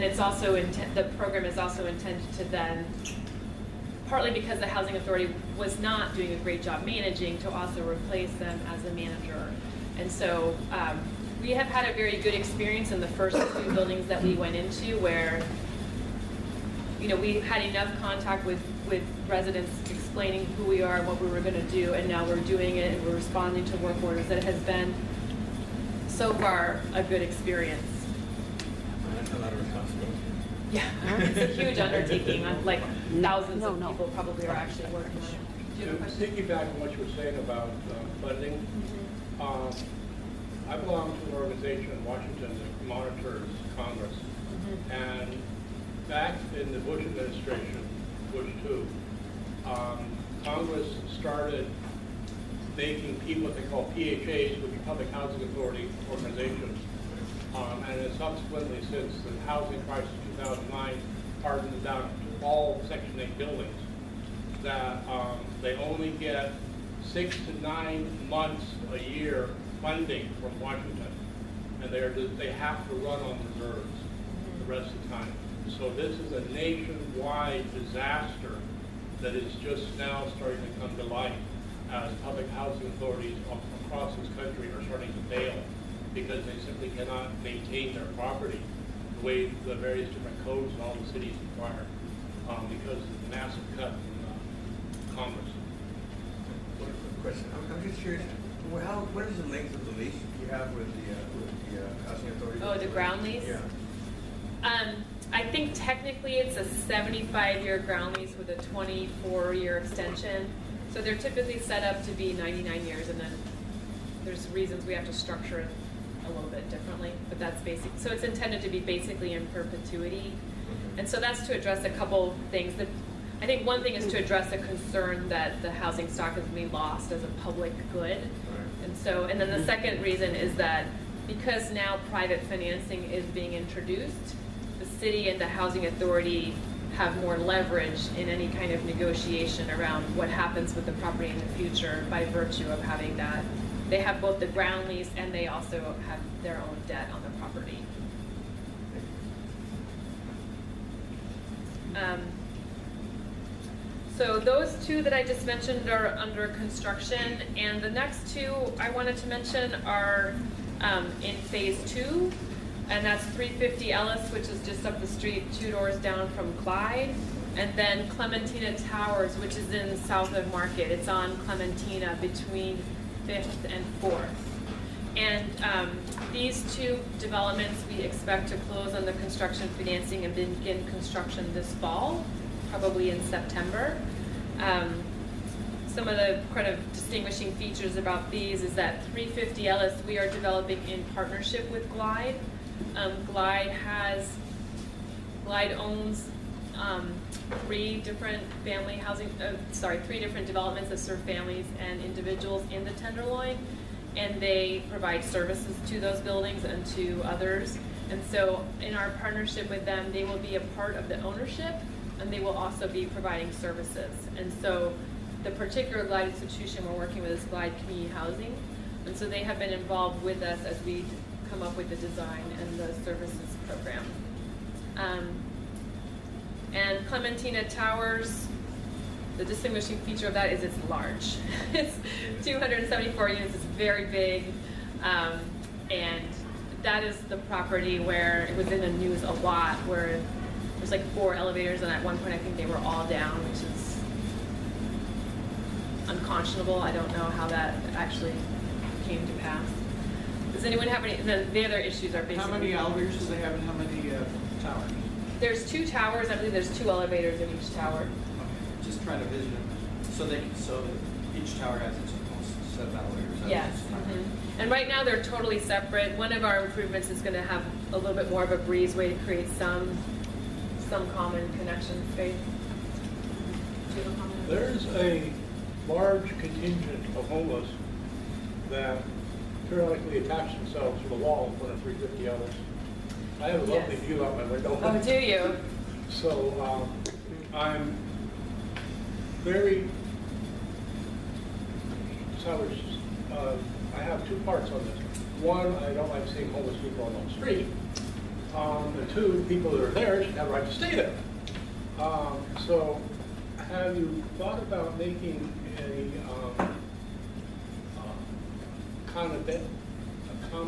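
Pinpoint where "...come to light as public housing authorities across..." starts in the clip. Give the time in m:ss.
1:20.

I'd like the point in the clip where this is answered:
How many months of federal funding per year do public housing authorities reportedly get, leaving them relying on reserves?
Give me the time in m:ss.
1:07.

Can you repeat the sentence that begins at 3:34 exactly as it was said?
And so the particular Glide institution we're working with is Glide Community Housing.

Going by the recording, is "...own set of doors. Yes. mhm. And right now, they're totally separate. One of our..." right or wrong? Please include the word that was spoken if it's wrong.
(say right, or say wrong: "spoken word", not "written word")
wrong: "elevators", not "doors".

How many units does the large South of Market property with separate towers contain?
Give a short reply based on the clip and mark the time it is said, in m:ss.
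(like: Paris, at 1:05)
274, at 3:52.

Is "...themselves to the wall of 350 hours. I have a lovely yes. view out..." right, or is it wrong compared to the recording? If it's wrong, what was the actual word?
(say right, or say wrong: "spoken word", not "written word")
right.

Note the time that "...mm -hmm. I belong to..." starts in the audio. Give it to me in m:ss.
0:38.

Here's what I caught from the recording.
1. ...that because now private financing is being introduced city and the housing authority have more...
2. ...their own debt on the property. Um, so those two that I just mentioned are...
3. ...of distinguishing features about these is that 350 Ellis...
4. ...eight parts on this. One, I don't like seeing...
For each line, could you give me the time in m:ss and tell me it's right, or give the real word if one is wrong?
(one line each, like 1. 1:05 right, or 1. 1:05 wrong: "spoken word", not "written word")
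1. 2:10 right
2. 2:26 right
3. 3:06 right
4. 4:54 wrong: "two", not "eight".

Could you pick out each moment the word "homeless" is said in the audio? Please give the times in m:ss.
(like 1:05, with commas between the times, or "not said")
4:37, 4:56.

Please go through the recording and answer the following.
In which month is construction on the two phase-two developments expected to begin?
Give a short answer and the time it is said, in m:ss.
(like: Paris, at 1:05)
September, at 3:03.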